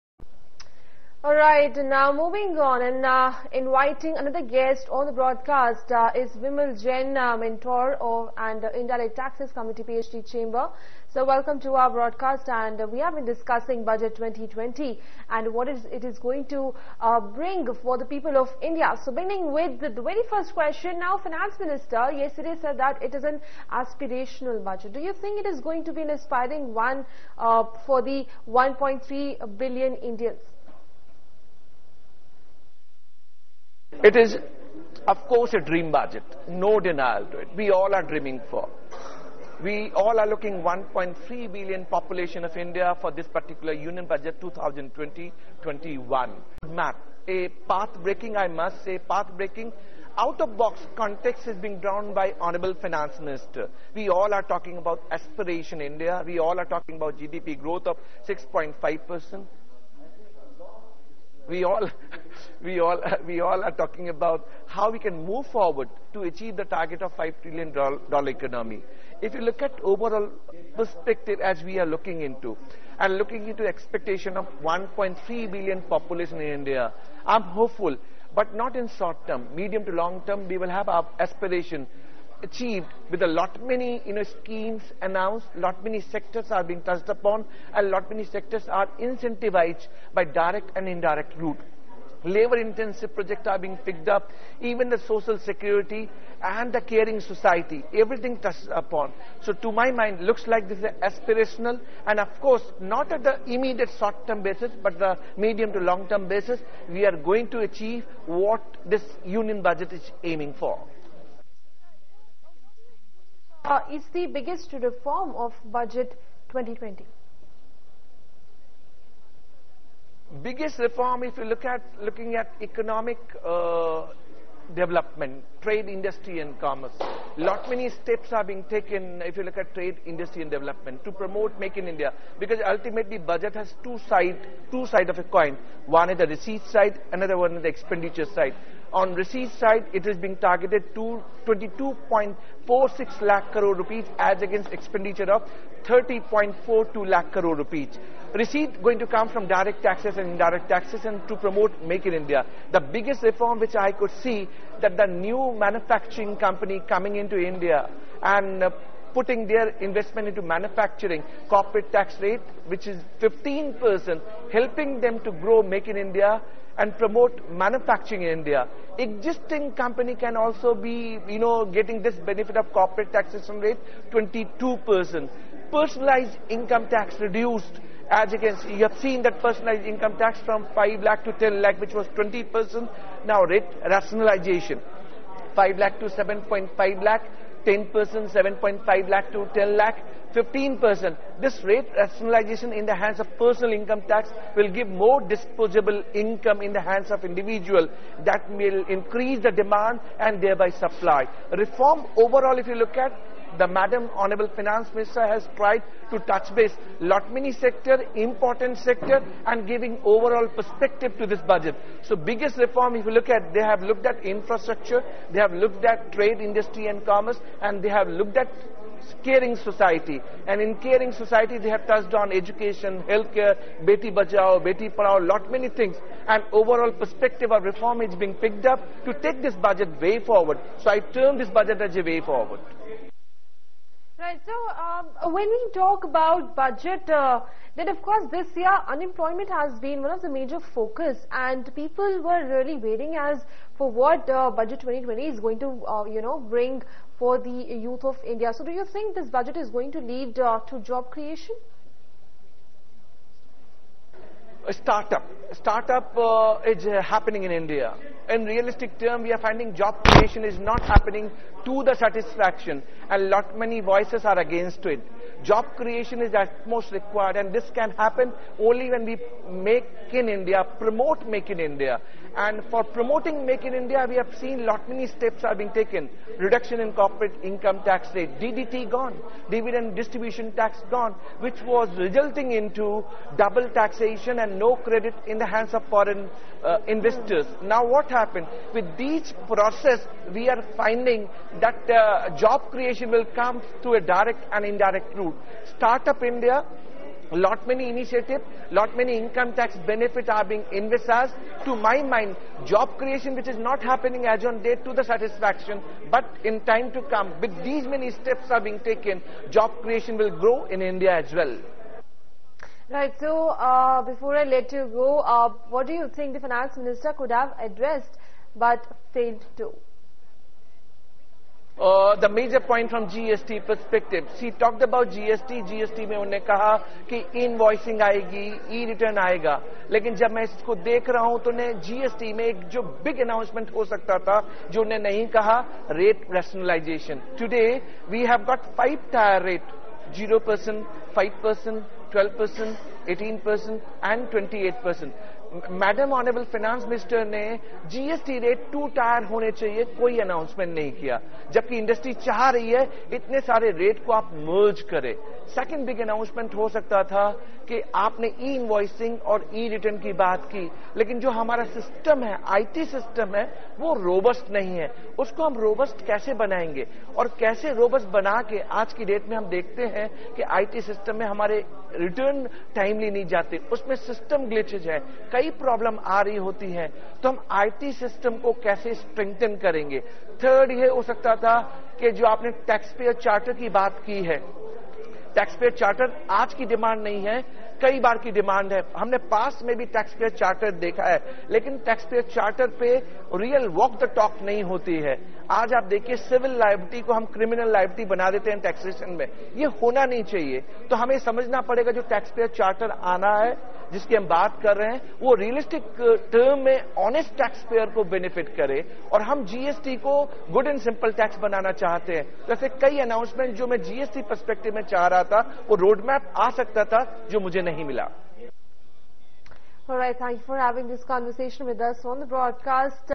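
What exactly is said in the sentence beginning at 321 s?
Uh, the major point from GST perspective.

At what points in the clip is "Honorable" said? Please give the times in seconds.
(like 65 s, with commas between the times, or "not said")
52 s, 204 s.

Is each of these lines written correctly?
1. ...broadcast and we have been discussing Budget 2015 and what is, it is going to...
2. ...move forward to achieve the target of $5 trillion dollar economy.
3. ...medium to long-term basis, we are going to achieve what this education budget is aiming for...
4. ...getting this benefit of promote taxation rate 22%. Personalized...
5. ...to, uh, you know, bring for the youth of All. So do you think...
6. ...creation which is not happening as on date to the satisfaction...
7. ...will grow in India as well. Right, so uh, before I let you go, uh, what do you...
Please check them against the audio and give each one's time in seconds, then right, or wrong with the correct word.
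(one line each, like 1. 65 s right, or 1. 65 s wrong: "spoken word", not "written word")
1. 11 s wrong: "2020", not "2015"
2. 65 s right
3. 105 s wrong: "union", not "education"
4. 171 s wrong: "corporate", not "promote"
5. 245 s wrong: "India", not "All"
6. 302 s right
7. 310 s right.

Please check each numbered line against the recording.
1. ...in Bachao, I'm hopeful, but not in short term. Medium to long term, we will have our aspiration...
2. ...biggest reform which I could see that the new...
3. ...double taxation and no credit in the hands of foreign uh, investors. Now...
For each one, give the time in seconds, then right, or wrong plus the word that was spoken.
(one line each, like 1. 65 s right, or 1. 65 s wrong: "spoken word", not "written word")
1. 76 s wrong: "India", not "Bachao"
2. 152 s right
3. 283 s right.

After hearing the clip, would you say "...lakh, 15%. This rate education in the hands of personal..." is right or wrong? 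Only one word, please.
wrong.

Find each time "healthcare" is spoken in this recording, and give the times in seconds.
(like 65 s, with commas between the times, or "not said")
223 s.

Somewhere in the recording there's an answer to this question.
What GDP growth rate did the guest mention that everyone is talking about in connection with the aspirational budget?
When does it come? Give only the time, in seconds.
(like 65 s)
58 s.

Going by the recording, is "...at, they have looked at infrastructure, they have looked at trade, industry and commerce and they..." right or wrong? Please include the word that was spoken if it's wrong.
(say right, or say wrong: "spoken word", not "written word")
right.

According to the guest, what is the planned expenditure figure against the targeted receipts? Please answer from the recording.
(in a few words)
30.42 lakh crore rupees.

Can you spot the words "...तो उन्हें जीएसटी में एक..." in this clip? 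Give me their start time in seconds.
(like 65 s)
331 s.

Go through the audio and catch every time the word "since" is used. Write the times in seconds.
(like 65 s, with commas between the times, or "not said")
not said.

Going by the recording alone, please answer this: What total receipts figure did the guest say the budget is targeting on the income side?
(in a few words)
22.46 lakh crore rupees.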